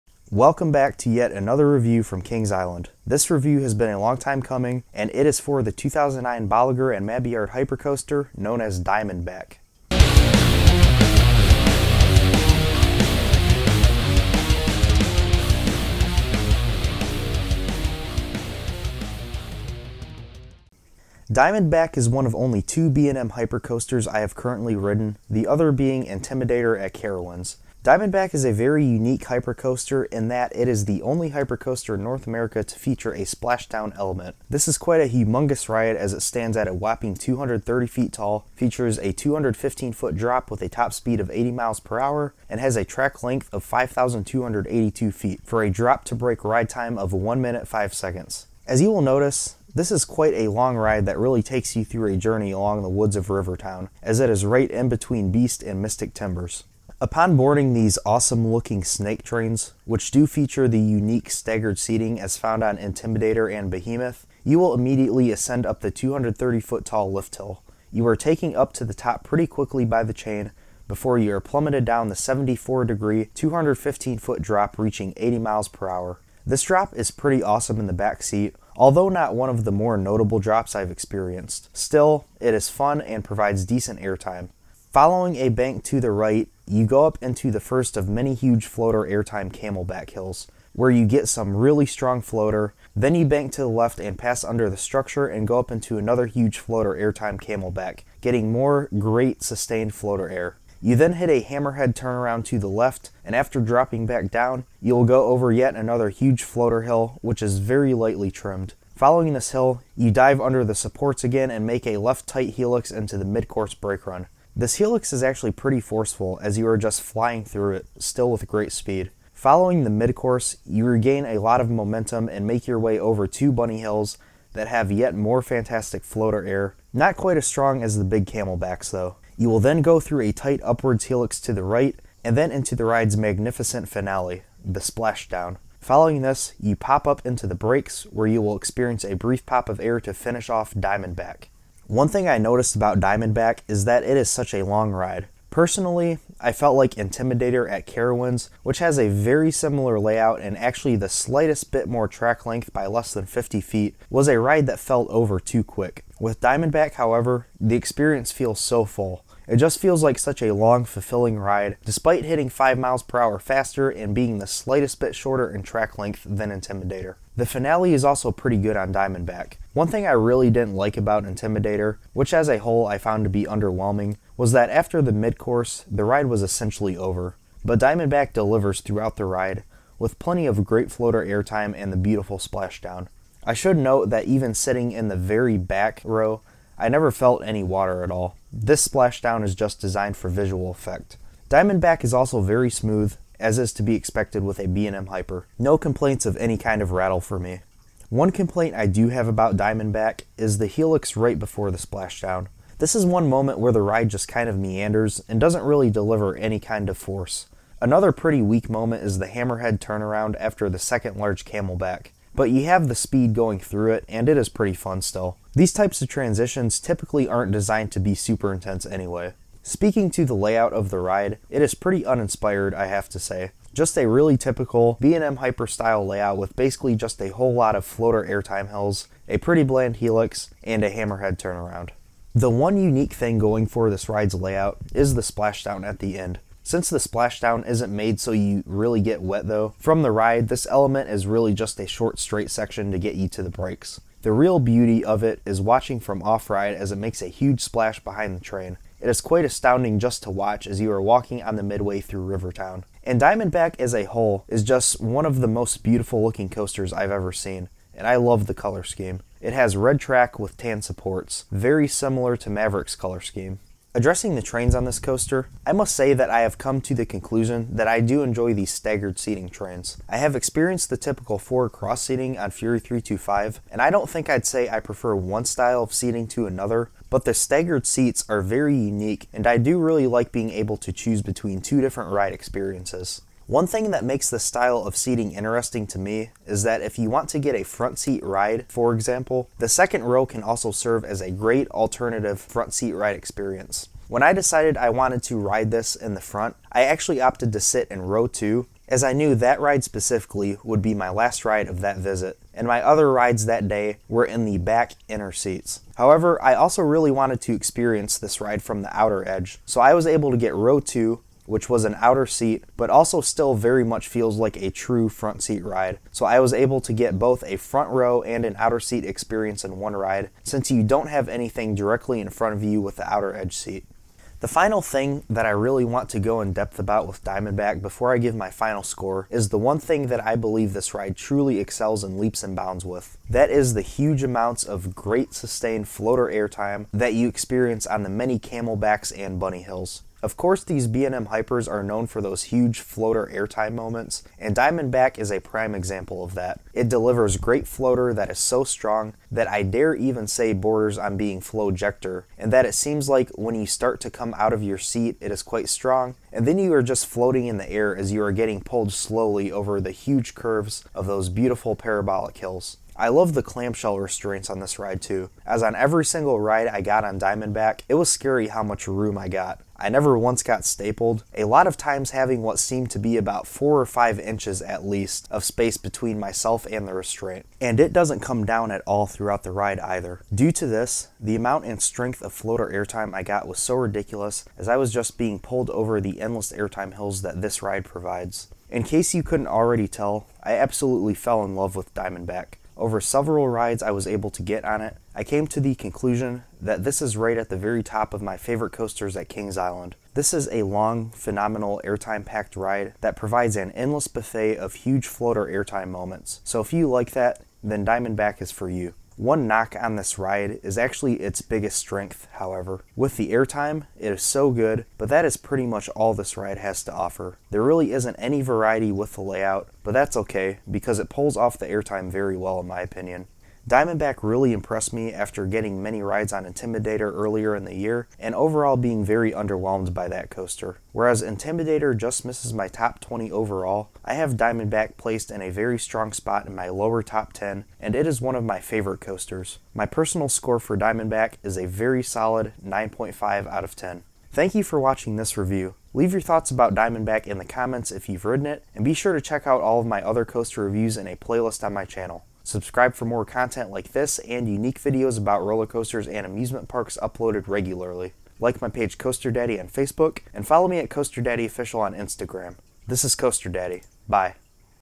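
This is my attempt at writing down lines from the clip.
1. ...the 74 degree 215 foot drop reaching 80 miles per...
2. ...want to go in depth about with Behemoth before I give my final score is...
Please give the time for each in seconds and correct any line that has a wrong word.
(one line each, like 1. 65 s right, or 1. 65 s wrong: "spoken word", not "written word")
1. 72 s right
2. 325 s wrong: "Diamondback", not "Behemoth".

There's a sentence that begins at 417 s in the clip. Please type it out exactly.
There really isn't any variety with the layout, but that's okay, because it pulls off the airtime very well in my opinion.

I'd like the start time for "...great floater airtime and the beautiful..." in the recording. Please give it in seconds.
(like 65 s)
180 s.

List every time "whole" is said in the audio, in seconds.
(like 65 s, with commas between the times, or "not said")
172 s, 227 s, 254 s.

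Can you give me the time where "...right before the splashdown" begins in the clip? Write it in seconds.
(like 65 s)
201 s.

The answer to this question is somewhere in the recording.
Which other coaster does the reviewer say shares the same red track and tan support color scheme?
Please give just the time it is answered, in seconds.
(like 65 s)
262 s.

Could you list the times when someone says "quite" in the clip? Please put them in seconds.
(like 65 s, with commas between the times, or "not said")
34 s, 50 s, 127 s, 249 s, 355 s.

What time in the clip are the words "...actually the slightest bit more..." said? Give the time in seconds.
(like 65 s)
150 s.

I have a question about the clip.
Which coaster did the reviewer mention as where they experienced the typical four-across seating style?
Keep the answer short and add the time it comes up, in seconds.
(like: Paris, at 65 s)
Fury 325, at 272 s.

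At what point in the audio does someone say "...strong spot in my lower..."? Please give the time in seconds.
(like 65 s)
435 s.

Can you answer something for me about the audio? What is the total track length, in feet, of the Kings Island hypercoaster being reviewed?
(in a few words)
5,282 feet.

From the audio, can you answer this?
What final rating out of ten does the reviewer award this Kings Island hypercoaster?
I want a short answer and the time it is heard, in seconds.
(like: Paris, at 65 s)
9.5, at 442 s.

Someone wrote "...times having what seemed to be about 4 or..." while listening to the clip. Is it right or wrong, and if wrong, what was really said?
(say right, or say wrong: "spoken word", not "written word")
right.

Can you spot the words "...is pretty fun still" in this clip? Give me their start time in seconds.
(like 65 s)
214 s.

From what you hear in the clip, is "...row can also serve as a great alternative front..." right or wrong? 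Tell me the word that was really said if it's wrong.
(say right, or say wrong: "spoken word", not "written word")
right.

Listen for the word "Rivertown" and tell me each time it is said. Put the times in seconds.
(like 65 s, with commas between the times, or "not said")
53 s, 252 s.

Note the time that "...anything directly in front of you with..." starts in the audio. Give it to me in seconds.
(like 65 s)
321 s.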